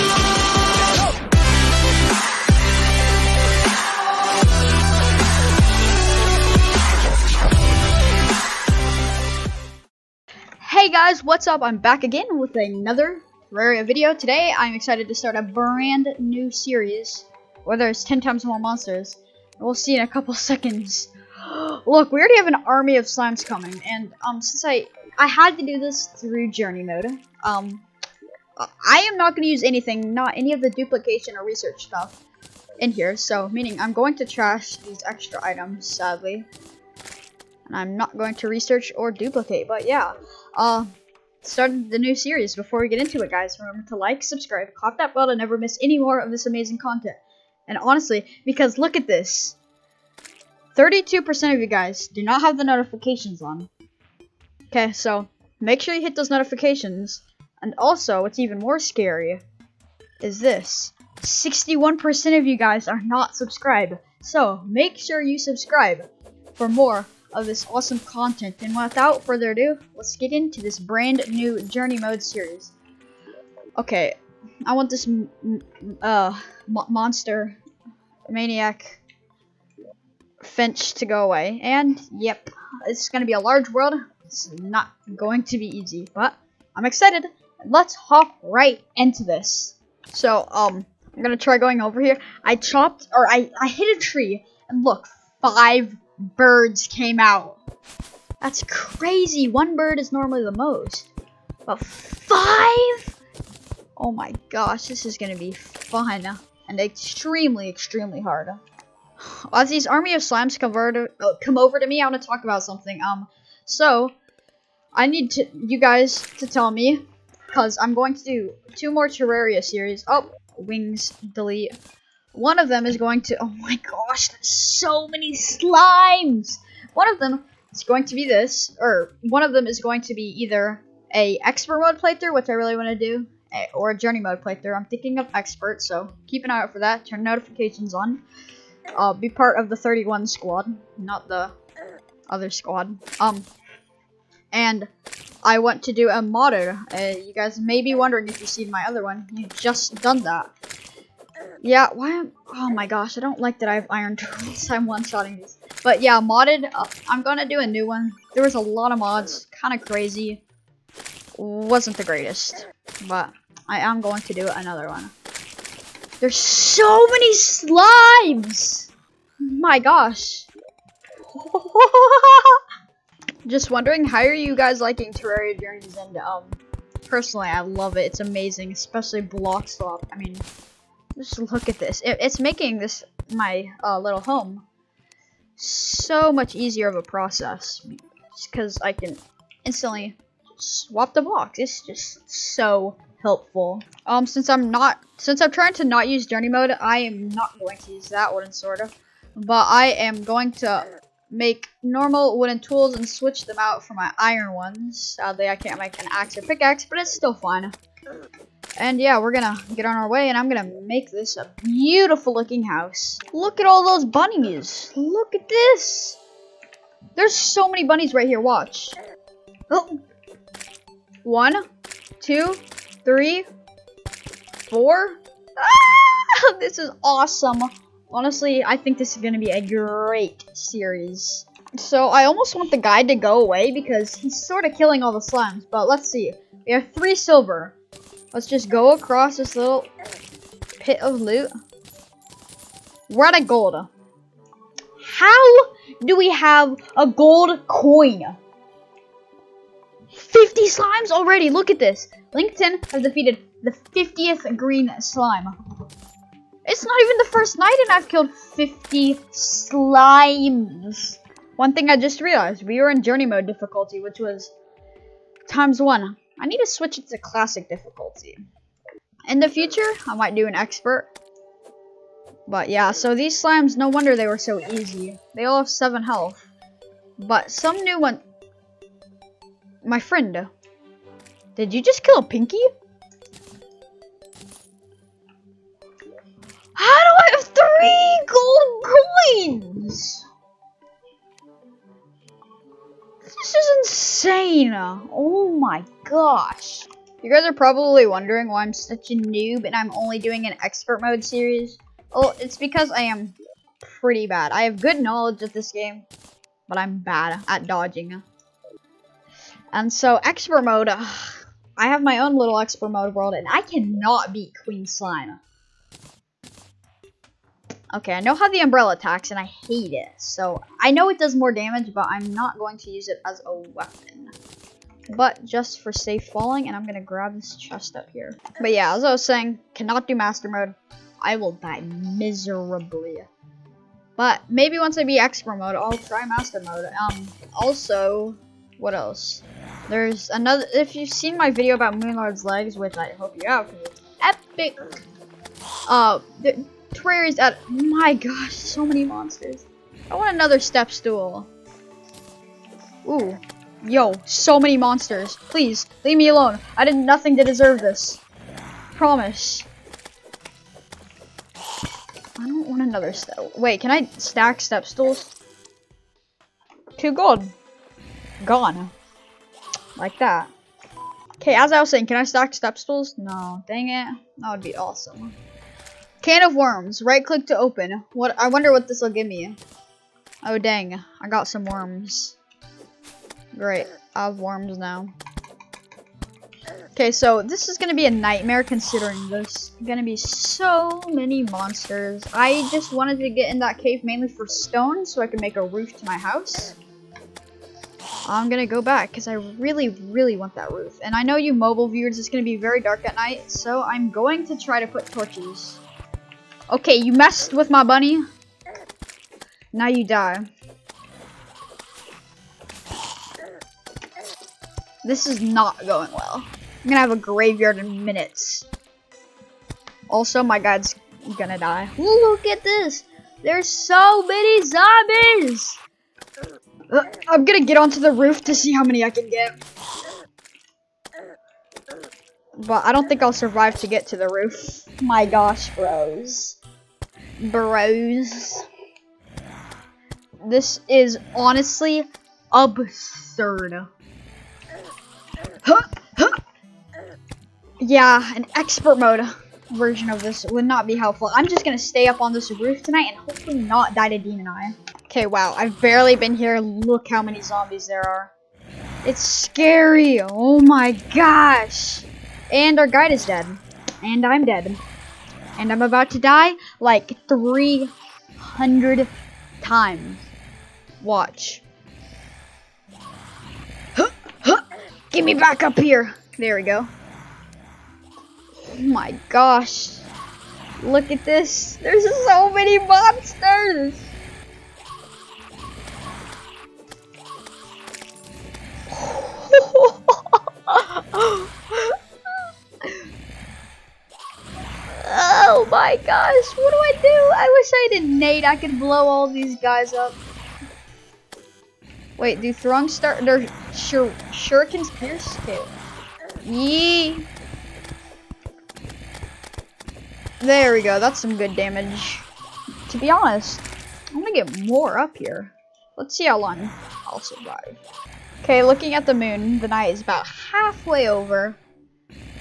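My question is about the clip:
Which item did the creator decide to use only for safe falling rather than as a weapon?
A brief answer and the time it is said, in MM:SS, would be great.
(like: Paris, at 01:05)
umbrella, at 05:18.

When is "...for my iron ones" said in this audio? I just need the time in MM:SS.
03:23.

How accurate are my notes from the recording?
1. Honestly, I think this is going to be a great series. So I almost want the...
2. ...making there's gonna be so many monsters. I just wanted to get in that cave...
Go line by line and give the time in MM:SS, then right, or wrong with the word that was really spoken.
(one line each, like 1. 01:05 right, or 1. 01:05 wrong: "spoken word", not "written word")
1. 03:48 right
2. 06:28 wrong: "considering", not "making".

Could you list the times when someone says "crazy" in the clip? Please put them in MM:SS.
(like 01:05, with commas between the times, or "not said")
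01:38, 02:39.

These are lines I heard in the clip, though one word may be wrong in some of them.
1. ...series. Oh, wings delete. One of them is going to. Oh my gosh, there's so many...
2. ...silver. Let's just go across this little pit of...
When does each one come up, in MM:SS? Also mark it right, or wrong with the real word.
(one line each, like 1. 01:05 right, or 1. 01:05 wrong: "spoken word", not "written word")
1. 01:59 right
2. 03:57 right.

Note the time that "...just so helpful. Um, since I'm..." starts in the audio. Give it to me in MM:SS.
03:11.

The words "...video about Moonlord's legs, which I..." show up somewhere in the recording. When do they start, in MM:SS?
05:41.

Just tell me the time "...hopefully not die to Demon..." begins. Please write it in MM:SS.
07:33.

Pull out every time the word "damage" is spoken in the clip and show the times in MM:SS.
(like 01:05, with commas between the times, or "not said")
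05:21, 08:31.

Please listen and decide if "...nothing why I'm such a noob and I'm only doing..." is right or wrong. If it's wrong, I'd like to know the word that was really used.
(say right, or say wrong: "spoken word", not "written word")
wrong: "wondering", not "nothing".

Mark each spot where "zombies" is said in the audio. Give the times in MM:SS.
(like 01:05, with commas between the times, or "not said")
07:04, 07:37.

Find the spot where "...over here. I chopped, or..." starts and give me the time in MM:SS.
01:31.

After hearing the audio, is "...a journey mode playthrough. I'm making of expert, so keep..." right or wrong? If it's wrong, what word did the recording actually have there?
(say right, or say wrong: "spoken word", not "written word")
wrong: "thinking", not "making".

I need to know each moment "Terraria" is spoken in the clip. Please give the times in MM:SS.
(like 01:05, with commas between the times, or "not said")
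00:13, 01:59, 02:55, 05:46.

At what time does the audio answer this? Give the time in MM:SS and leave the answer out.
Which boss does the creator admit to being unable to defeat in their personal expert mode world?
05:14.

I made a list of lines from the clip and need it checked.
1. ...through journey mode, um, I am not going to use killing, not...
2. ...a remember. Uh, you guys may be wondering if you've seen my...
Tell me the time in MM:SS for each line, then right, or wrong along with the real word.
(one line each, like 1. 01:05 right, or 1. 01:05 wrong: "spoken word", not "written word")
1. 00:26 wrong: "anything", not "killing"
2. 02:26 wrong: "modder", not "remember".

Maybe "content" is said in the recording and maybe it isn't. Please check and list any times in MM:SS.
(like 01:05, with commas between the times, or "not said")
00:46, 01:07.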